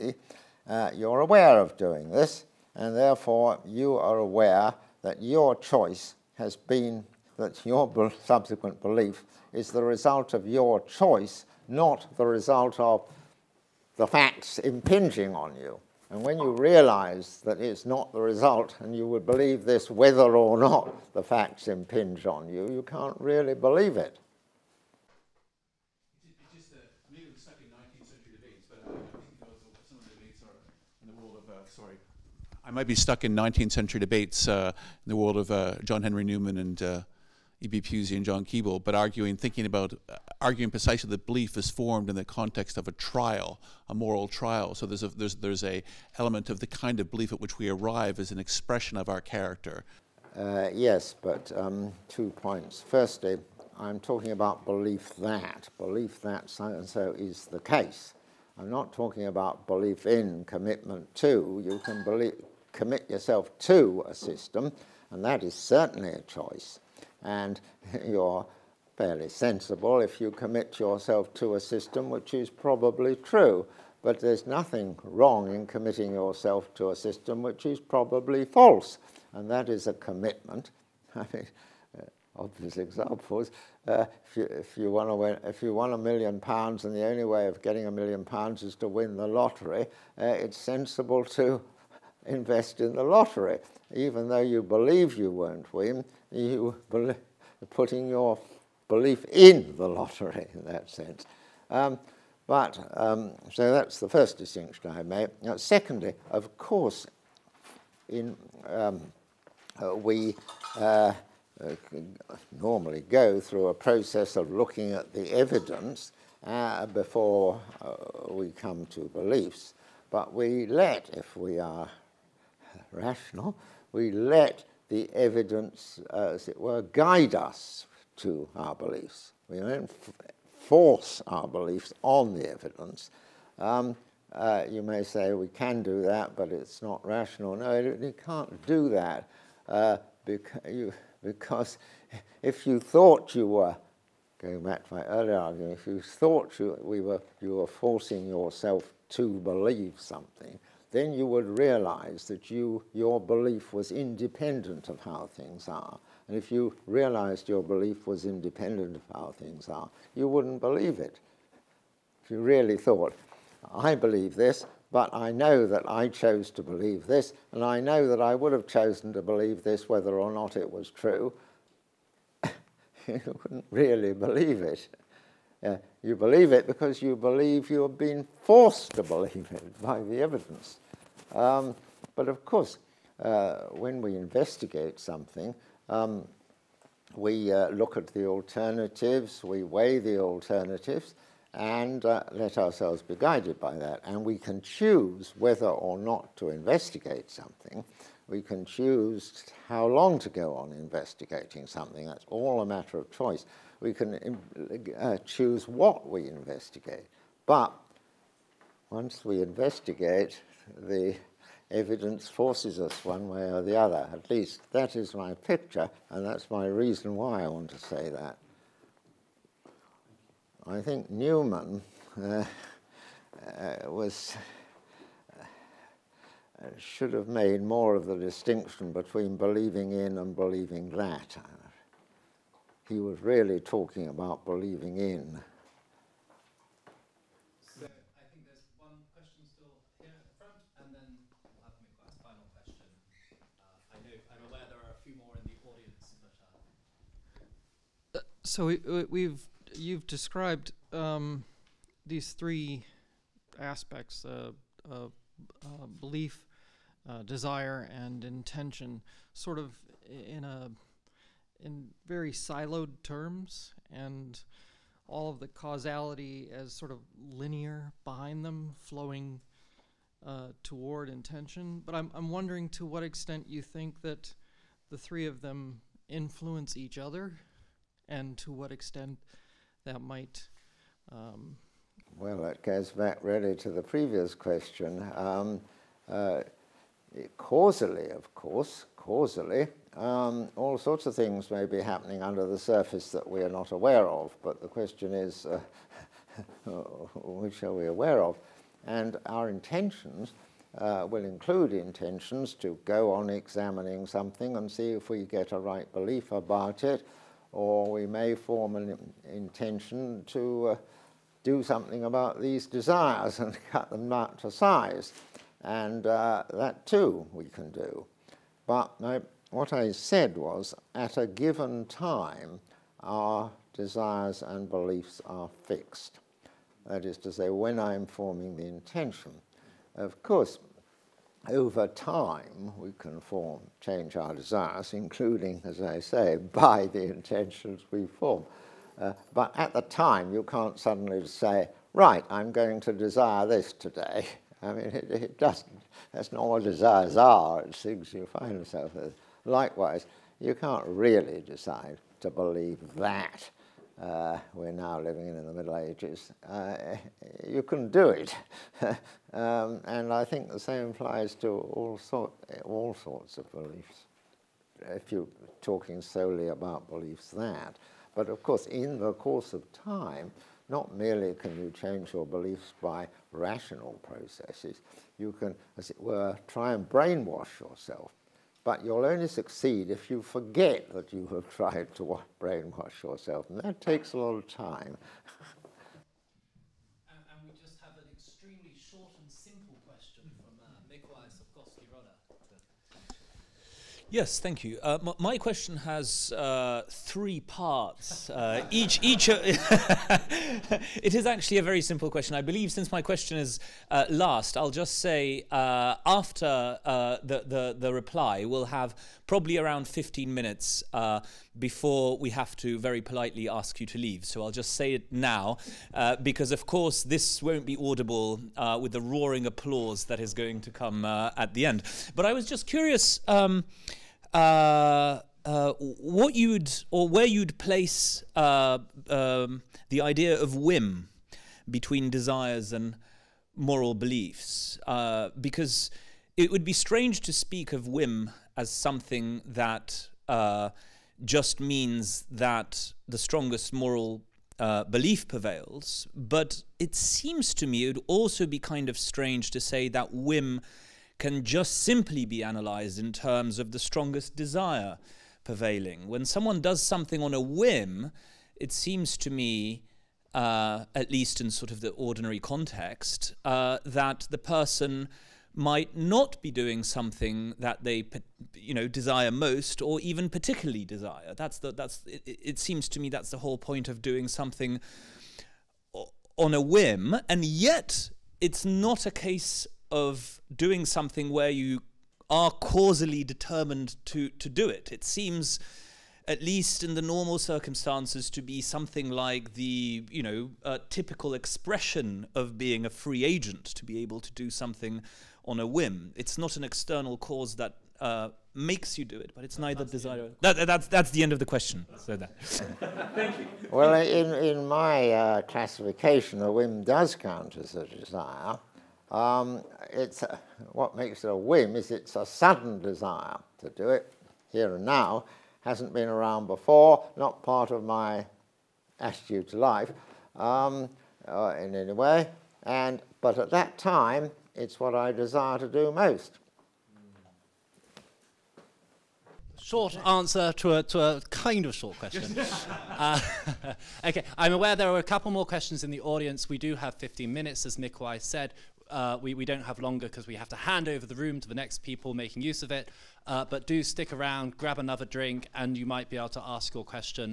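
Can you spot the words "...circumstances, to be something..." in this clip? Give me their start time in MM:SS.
08:07.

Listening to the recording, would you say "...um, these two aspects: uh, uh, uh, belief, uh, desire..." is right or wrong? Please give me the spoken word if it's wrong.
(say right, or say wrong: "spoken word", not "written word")
wrong: "three", not "two".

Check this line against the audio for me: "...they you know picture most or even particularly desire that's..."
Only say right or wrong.
wrong.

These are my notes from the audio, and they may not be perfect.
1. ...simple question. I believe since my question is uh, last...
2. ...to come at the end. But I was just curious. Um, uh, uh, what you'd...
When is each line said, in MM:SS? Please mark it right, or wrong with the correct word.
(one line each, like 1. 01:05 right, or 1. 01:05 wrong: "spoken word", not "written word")
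1. 06:41 right
2. 07:00 right.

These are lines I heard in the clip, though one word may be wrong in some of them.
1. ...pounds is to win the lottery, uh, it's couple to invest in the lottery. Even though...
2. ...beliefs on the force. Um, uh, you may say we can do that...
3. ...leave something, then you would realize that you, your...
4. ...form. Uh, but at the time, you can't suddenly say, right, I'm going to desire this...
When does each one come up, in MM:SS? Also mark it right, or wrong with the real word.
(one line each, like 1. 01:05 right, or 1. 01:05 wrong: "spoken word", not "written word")
1. 01:28 wrong: "sensible", not "couple"
2. 02:11 wrong: "evidence", not "force"
3. 02:29 wrong: "believe", not "leave"
4. 05:38 right.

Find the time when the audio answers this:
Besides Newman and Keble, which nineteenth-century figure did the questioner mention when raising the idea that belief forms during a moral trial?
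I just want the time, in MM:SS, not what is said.
00:37.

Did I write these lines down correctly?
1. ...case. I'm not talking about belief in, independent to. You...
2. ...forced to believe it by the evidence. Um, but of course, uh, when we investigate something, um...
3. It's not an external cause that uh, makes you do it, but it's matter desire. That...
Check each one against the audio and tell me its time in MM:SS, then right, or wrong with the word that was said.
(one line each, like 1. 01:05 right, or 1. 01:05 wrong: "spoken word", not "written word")
1. 00:57 wrong: "commitment", not "independent"
2. 02:58 right
3. 08:16 wrong: "neither", not "matter".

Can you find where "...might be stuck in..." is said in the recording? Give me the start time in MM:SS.
00:32.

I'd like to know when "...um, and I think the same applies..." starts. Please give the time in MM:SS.
05:59.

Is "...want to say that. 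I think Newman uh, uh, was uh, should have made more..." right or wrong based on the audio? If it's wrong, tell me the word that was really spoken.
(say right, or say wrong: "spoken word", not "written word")
right.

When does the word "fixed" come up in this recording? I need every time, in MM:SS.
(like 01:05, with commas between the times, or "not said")
05:25.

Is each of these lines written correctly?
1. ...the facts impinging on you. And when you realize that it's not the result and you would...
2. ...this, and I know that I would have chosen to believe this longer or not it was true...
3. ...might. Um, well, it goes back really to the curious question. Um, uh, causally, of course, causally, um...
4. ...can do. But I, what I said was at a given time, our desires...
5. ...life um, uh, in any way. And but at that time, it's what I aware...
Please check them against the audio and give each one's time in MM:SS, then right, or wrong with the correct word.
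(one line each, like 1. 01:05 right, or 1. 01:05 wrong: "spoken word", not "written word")
1. 00:13 right
2. 02:47 wrong: "whether", not "longer"
3. 04:40 wrong: "previous", not "curious"
4. 05:17 right
5. 08:39 wrong: "desire", not "aware".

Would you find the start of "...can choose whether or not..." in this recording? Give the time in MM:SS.
03:14.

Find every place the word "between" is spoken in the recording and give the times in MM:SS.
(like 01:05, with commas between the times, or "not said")
03:48, 07:11.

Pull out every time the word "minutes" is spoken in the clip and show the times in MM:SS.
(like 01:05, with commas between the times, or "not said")
06:50, 08:57.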